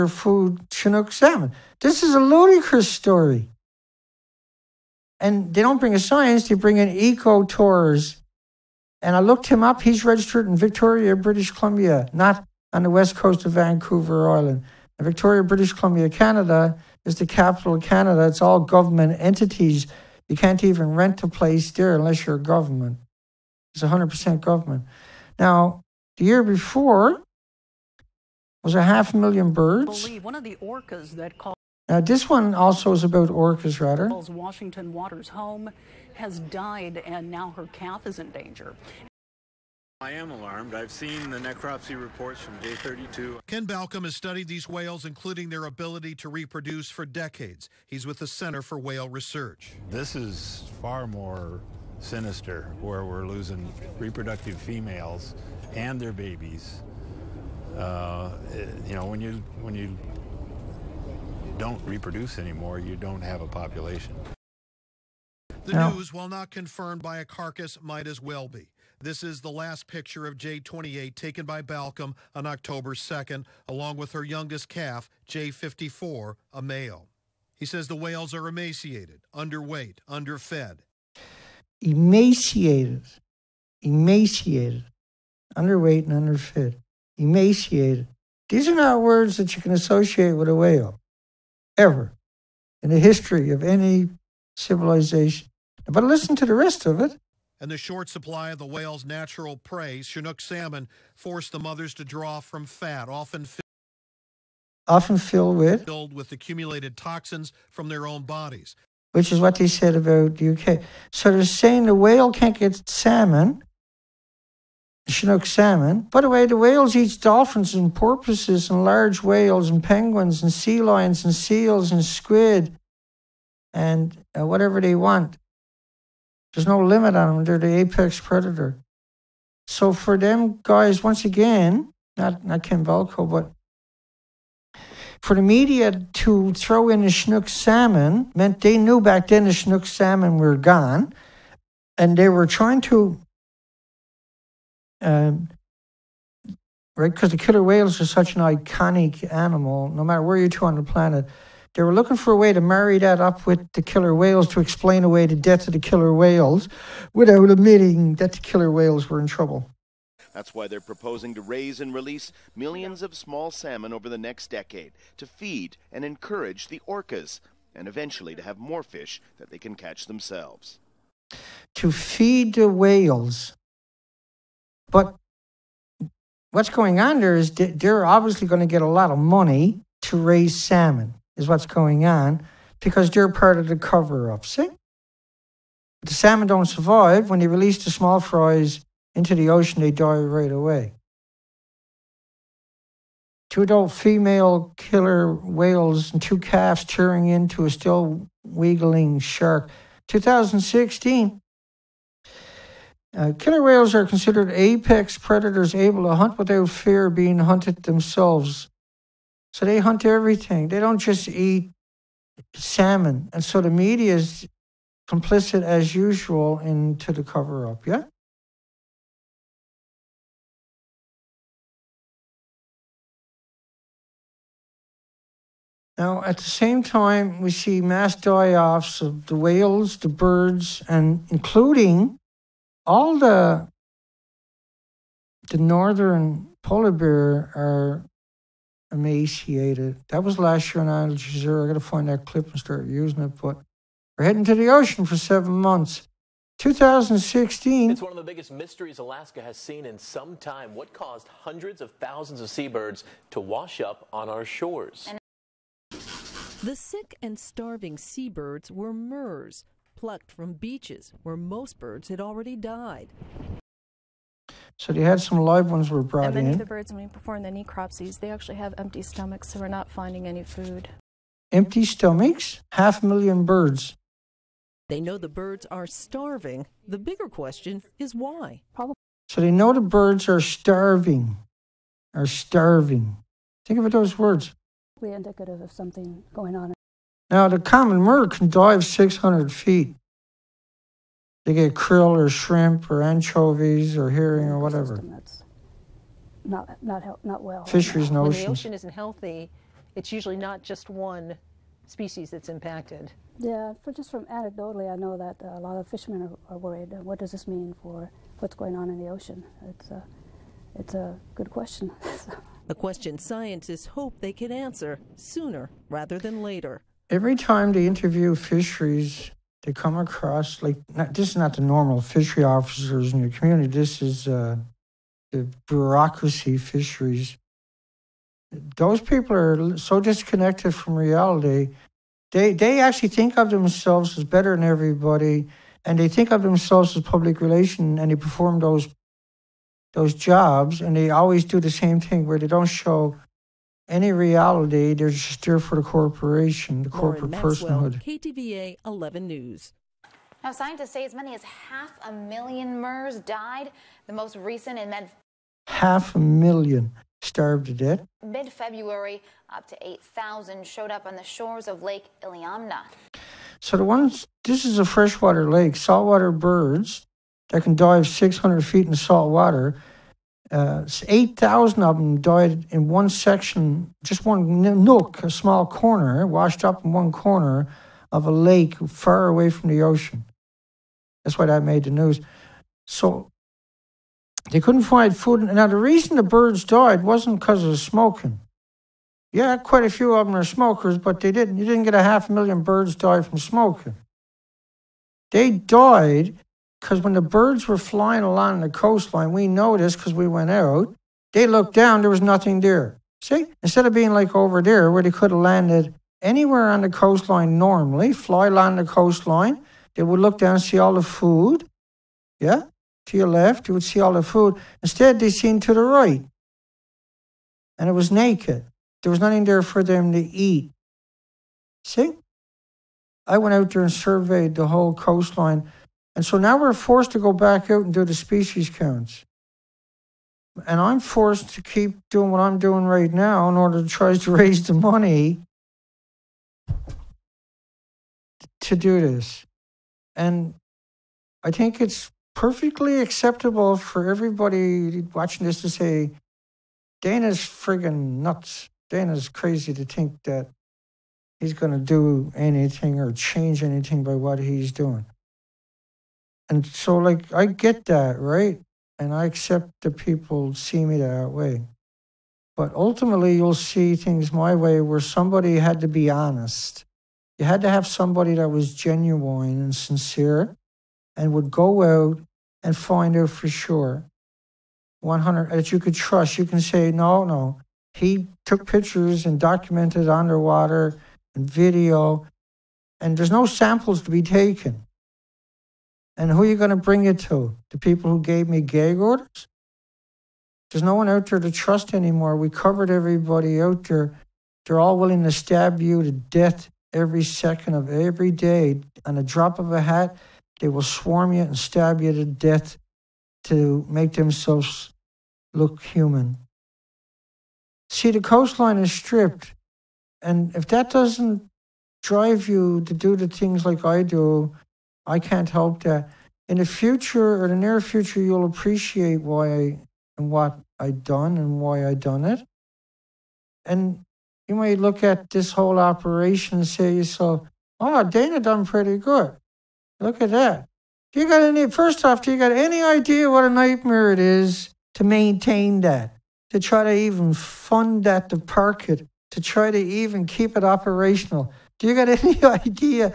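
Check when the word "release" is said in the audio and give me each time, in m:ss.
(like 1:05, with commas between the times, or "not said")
2:41, 3:07.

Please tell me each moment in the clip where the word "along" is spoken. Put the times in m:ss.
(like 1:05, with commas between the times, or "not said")
1:13, 6:38, 6:48.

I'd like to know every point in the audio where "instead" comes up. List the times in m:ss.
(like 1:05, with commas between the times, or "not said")
6:43, 6:54.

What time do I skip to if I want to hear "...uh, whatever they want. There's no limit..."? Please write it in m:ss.
2:04.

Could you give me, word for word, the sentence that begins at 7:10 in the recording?
And I'm forced to keep doing what I'm doing right now in order to try to raise the money to do this.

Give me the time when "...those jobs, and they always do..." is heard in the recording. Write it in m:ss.
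5:39.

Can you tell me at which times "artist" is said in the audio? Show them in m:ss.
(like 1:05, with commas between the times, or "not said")
not said.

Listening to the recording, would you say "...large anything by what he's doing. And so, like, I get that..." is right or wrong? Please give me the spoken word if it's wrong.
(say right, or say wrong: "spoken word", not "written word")
wrong: "change", not "large".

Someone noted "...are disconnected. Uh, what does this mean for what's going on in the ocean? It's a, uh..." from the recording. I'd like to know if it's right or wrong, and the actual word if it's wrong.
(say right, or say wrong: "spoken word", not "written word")
wrong: "worried", not "disconnected".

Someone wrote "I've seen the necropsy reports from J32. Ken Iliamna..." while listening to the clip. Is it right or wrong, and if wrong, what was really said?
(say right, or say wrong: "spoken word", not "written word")
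wrong: "Balcomb", not "Iliamna".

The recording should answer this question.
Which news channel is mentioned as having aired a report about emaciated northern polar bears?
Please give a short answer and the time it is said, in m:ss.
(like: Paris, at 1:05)
Al Jazeera, at 4:00.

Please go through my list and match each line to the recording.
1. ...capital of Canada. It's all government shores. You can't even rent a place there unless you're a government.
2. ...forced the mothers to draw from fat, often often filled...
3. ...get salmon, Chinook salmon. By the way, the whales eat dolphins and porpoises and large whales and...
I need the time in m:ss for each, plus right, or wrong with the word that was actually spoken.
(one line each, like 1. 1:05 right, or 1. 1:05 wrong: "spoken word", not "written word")
1. 0:17 wrong: "entities", not "shores"
2. 1:41 right
3. 1:52 right.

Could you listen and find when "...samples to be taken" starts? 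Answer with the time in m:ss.
8:03.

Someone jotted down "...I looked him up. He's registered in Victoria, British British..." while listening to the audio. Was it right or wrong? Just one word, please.
wrong.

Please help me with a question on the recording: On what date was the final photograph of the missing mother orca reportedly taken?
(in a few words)
October 2nd.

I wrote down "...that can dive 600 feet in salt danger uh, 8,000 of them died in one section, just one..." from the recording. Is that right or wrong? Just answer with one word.
wrong.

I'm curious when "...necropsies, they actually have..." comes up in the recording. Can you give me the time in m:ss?
4:27.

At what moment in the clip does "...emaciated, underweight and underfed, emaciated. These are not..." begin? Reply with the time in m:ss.
1:23.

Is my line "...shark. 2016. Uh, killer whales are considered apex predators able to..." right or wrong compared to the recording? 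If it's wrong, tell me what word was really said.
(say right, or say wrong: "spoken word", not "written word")
right.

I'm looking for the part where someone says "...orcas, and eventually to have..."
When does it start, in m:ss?
2:46.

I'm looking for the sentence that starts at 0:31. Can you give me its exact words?
Now, this one also is about orcas, rather.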